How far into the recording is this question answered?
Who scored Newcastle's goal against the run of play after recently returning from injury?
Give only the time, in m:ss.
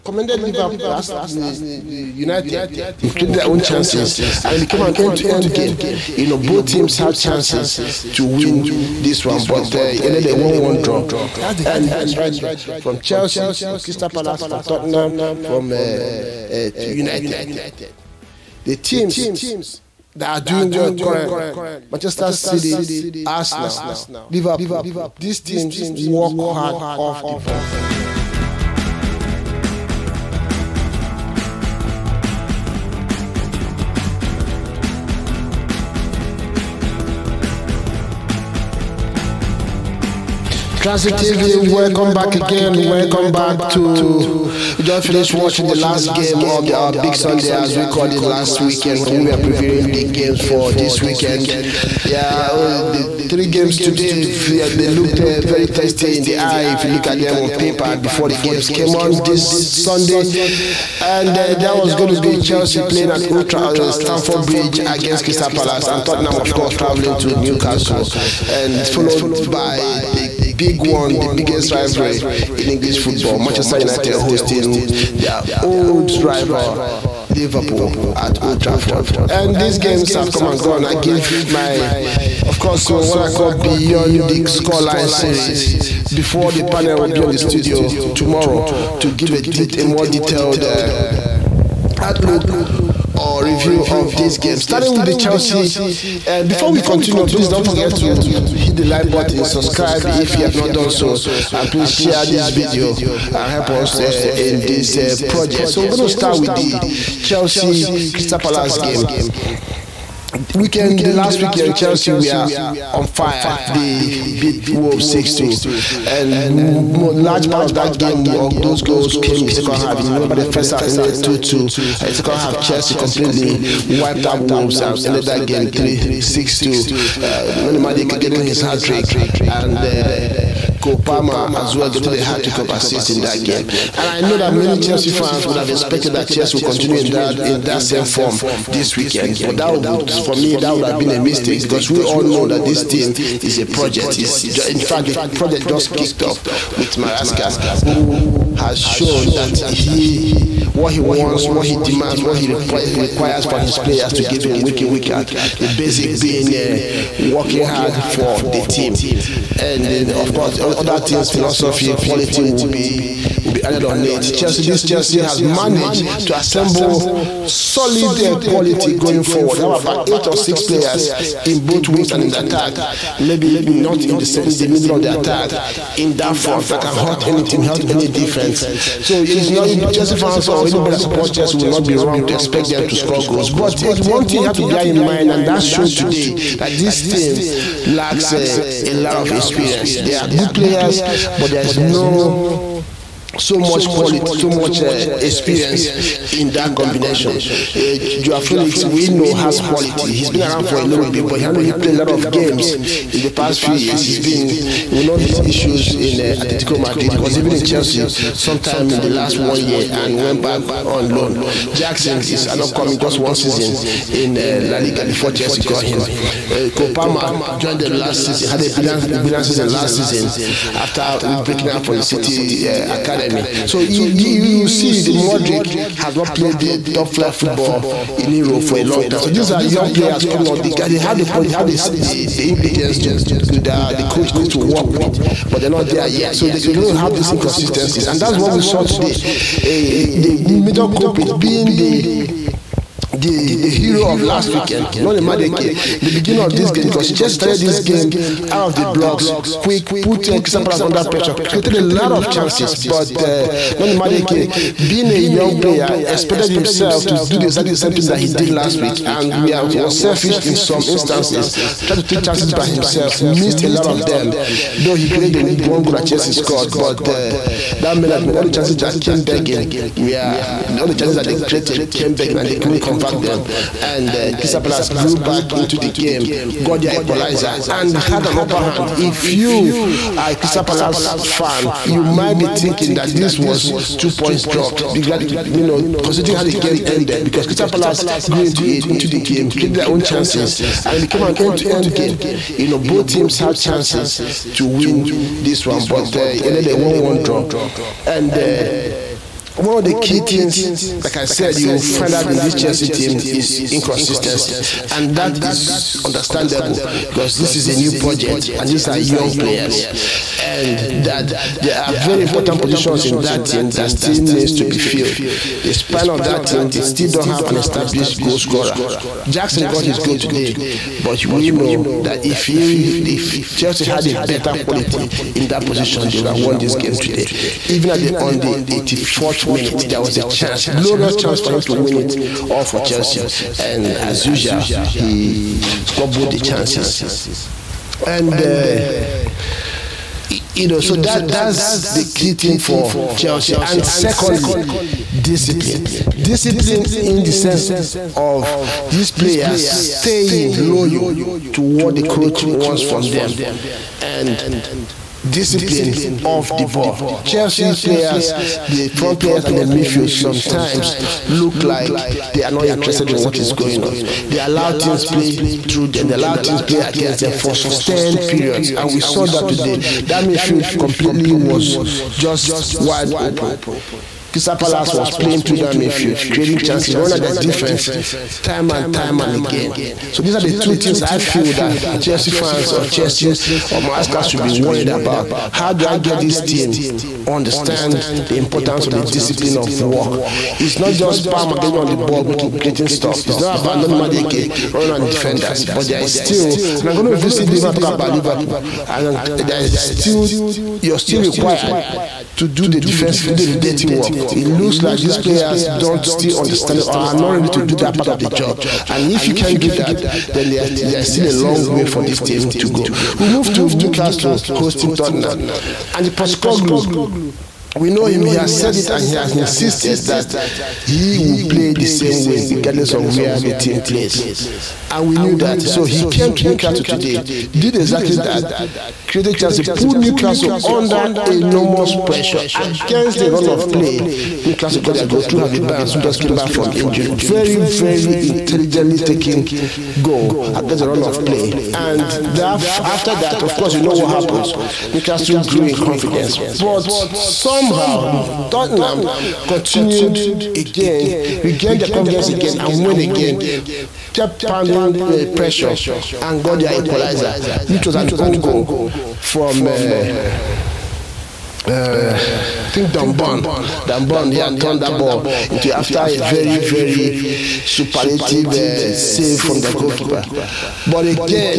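7:15.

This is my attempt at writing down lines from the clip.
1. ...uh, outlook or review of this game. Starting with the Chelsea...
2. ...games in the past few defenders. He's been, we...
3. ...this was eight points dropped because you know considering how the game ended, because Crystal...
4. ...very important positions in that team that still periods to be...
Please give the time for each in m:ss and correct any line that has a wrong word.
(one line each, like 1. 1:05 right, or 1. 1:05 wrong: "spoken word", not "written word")
1. 1:30 right
2. 3:22 wrong: "years", not "defenders"
3. 4:43 wrong: "two", not "eight"
4. 5:11 wrong: "needs", not "periods".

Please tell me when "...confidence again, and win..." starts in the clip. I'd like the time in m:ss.
7:31.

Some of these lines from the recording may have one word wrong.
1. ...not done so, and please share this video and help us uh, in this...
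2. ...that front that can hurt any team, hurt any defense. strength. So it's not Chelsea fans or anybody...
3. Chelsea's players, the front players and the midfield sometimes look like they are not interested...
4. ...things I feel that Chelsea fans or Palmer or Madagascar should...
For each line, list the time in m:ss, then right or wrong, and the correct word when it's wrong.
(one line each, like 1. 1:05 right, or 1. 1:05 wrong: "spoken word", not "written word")
1. 1:40 right
2. 2:56 right
3. 5:57 right
4. 6:20 wrong: "Chelsea", not "Palmer".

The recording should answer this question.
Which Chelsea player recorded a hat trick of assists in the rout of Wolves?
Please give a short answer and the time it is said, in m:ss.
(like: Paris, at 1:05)
Copama, at 2:10.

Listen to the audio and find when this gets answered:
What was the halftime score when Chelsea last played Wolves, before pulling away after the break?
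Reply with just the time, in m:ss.
2:01.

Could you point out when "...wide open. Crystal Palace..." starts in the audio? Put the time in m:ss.
6:12.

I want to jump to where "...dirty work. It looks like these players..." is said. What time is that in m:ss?
6:43.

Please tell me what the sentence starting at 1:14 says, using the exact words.
hosting their old rival Liverpool at Old Trafford.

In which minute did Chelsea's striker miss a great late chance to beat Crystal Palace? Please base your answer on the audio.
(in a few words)
84th minute.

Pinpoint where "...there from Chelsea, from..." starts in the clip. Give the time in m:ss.
0:12.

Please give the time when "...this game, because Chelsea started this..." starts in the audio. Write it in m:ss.
4:06.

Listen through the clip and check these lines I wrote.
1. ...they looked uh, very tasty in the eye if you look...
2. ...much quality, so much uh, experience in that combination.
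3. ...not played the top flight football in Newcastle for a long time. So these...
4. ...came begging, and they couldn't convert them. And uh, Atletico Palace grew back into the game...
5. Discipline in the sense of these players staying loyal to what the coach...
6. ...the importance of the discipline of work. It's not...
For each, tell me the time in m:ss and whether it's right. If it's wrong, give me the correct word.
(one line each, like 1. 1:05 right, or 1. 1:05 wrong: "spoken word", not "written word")
1. 0:54 right
2. 3:13 right
3. 3:46 wrong: "Europe", not "Newcastle"
4. 4:31 wrong: "Crystal", not "Atletico"
5. 5:46 right
6. 6:28 right.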